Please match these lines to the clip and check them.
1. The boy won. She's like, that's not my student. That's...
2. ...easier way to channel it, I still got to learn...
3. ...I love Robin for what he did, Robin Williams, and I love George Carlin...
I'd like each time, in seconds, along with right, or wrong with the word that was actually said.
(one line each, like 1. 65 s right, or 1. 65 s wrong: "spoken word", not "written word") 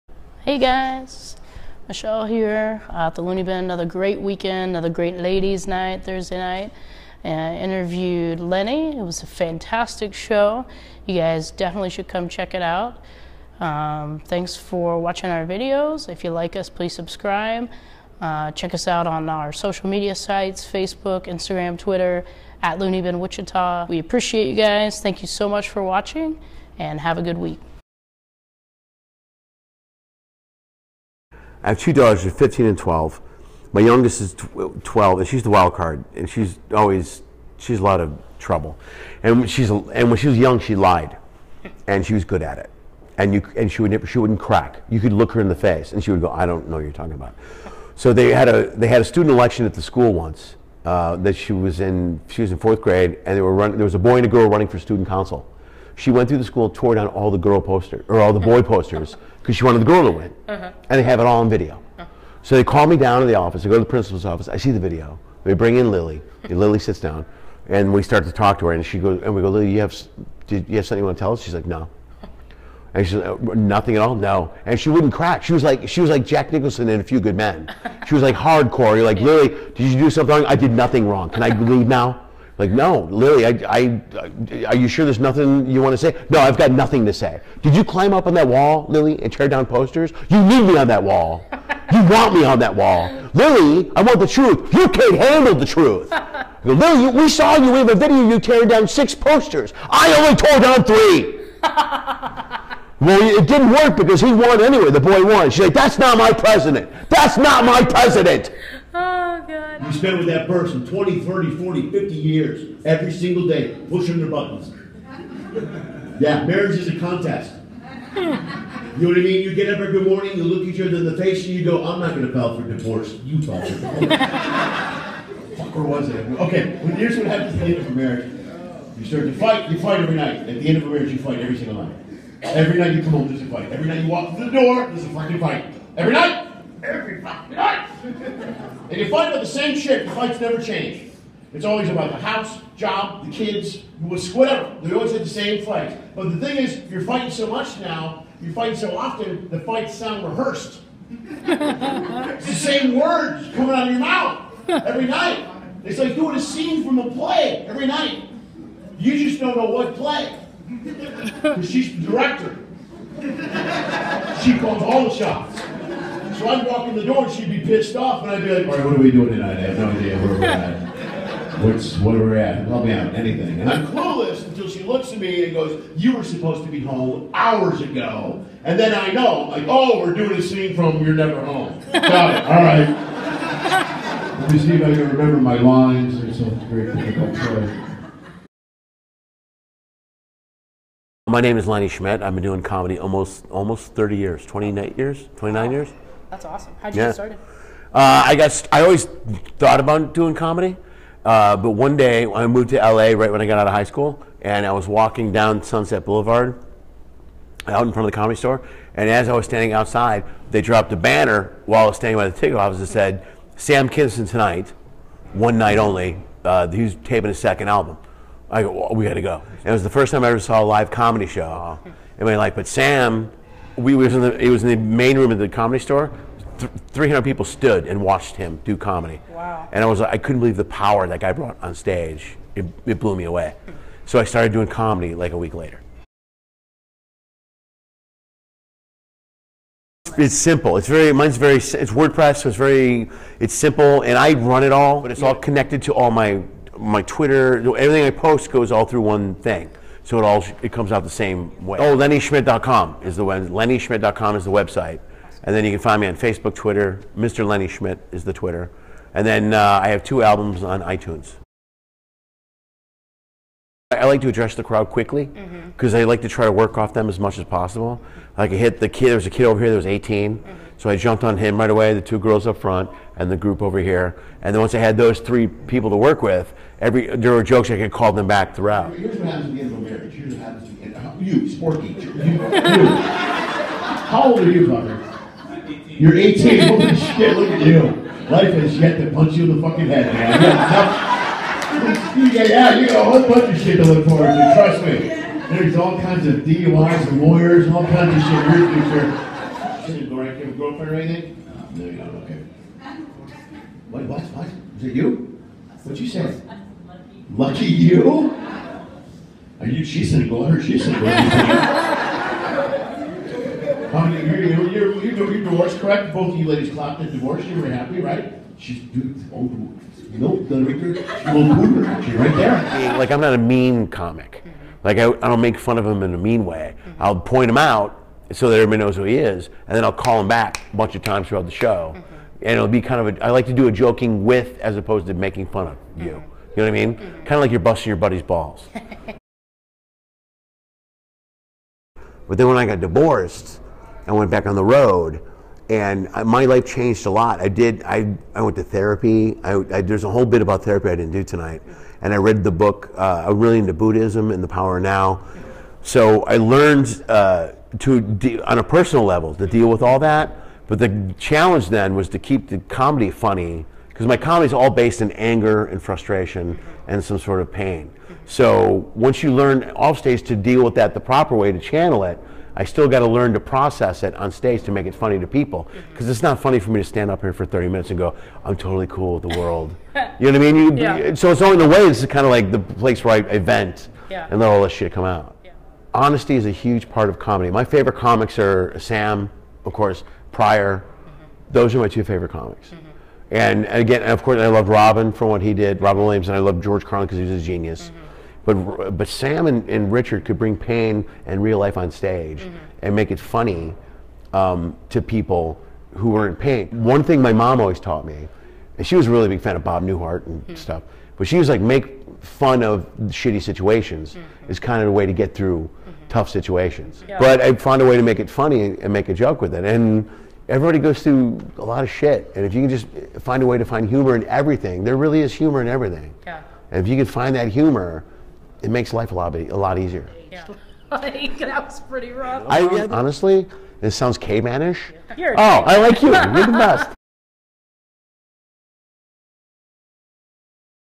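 1. 104 s wrong: "president", not "student"
2. 370 s wrong: "proper", not "easier"
3. 394 s right.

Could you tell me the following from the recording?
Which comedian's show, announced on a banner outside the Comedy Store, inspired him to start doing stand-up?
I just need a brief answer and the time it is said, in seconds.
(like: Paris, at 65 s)
Sam Kinison, at 213 s.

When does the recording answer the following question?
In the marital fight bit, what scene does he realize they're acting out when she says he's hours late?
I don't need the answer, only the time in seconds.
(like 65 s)
181 s.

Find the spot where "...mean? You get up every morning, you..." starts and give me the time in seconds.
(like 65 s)
119 s.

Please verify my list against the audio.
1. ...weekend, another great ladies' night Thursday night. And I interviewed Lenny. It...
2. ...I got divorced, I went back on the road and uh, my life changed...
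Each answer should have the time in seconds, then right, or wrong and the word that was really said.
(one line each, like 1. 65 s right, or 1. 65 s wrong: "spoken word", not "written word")
1. 4 s right
2. 342 s right.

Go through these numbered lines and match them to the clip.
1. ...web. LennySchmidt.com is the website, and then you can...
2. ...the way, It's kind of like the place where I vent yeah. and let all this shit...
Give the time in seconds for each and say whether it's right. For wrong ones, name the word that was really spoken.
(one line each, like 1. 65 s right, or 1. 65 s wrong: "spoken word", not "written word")
1. 253 s right
2. 381 s right.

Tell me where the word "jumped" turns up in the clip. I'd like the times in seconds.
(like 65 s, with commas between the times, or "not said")
270 s.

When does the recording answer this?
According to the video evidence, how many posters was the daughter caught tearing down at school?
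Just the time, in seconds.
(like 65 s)
98 s.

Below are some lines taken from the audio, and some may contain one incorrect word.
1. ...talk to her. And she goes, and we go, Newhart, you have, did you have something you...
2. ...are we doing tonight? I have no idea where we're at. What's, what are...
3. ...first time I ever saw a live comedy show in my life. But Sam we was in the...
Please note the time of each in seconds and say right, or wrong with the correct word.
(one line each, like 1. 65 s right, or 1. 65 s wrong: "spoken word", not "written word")
1. 68 s wrong: "Lily", not "Newhart"
2. 168 s right
3. 219 s right.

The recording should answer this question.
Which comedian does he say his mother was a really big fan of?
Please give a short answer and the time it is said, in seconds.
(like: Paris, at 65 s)
Bob Newhart, at 409 s.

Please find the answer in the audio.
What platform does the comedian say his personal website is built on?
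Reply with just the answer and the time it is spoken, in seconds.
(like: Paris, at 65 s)
WordPress, at 241 s.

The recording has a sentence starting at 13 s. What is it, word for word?
Um, thanks for watching our videos.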